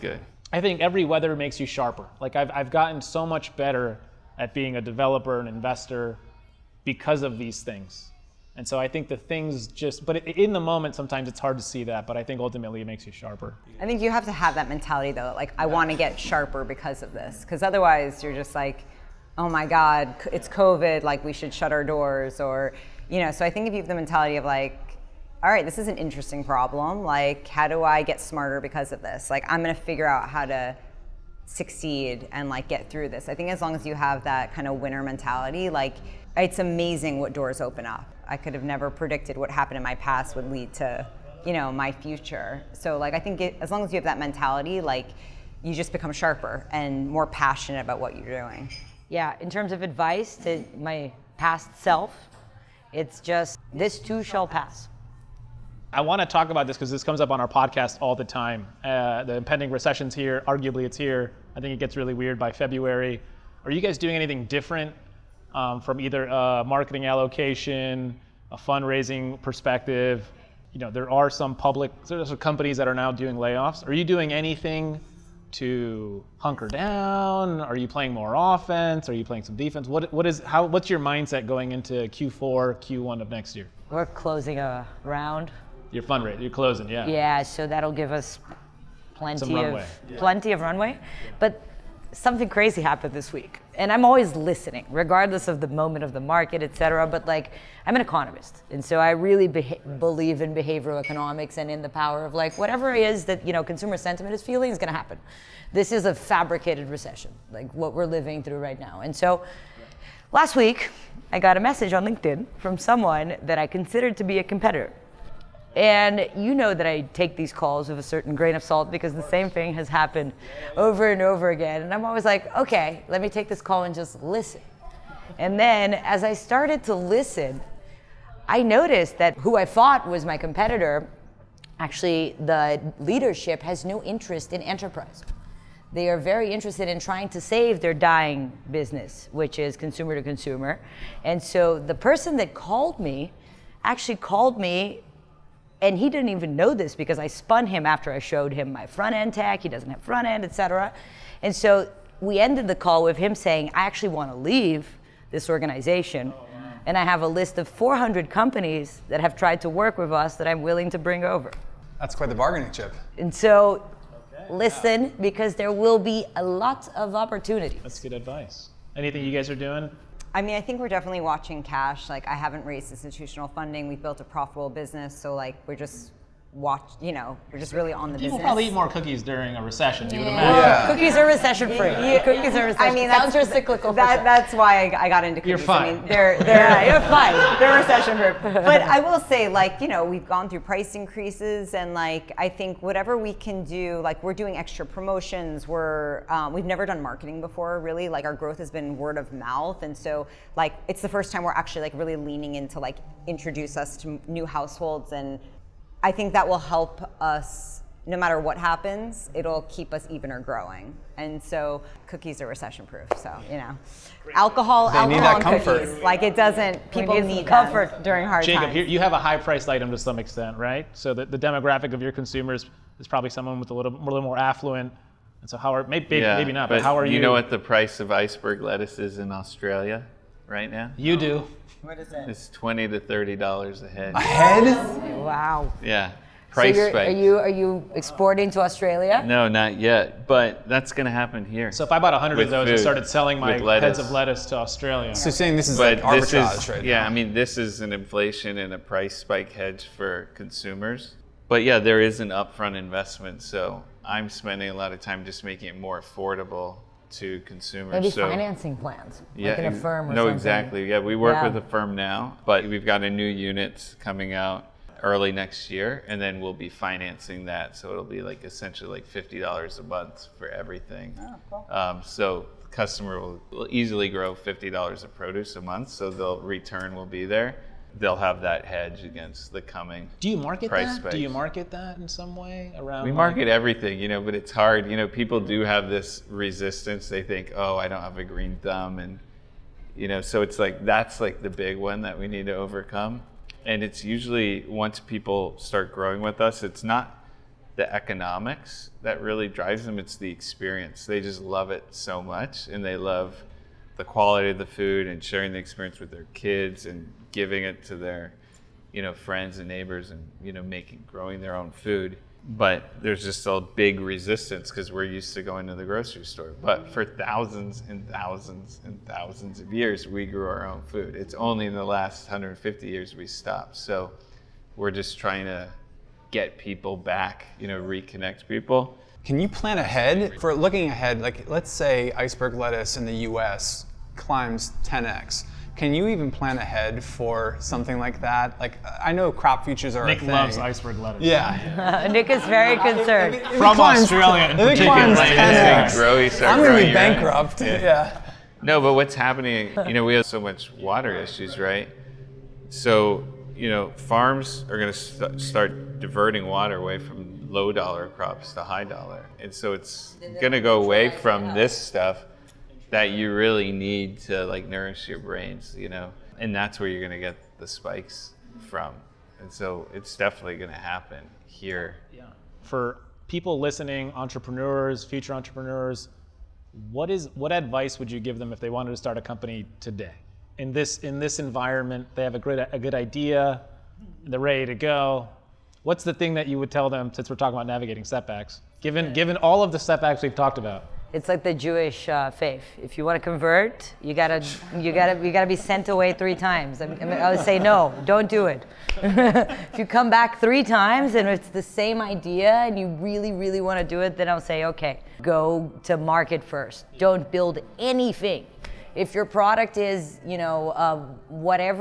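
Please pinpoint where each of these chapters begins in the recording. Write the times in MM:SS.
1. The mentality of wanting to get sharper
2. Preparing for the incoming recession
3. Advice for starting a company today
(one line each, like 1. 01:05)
1. 00:11
2. 00:54
3. 06:15.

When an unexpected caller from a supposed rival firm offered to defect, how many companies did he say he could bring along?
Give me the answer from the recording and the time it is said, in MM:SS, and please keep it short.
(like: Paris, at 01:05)
400, at 02:37.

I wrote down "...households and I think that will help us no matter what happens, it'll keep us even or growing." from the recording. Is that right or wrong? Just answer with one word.
right.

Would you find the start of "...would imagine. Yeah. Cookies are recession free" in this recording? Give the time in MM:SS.
03:00.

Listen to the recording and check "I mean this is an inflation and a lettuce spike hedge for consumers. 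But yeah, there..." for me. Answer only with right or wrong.
wrong.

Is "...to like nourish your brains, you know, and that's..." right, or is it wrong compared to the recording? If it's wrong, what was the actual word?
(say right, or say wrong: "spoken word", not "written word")
right.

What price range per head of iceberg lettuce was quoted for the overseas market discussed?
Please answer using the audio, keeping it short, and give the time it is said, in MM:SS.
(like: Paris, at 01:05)
$20 to $30, at 03:52.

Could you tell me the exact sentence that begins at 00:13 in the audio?
I think you have to have that mentality though, like, I want to get sharper because of this.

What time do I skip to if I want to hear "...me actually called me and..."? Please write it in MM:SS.
02:22.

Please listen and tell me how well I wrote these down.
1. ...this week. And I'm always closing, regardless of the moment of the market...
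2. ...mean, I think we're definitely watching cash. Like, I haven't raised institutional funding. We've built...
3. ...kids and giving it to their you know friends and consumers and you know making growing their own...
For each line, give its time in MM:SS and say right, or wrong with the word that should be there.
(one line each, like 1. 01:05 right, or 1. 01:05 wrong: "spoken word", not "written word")
1. 01:33 wrong: "listening", not "closing"
2. 02:50 right
3. 05:06 wrong: "neighbors", not "consumers".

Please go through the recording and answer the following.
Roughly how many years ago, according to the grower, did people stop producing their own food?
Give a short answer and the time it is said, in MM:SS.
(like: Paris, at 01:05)
150, at 05:22.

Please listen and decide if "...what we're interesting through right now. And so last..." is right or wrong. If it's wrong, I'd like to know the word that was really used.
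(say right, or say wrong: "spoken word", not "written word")
wrong: "living", not "interesting".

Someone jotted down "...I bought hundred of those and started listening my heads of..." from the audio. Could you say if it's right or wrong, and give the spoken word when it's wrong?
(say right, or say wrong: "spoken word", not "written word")
wrong: "selling", not "listening".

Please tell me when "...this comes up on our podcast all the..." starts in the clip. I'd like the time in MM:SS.
00:56.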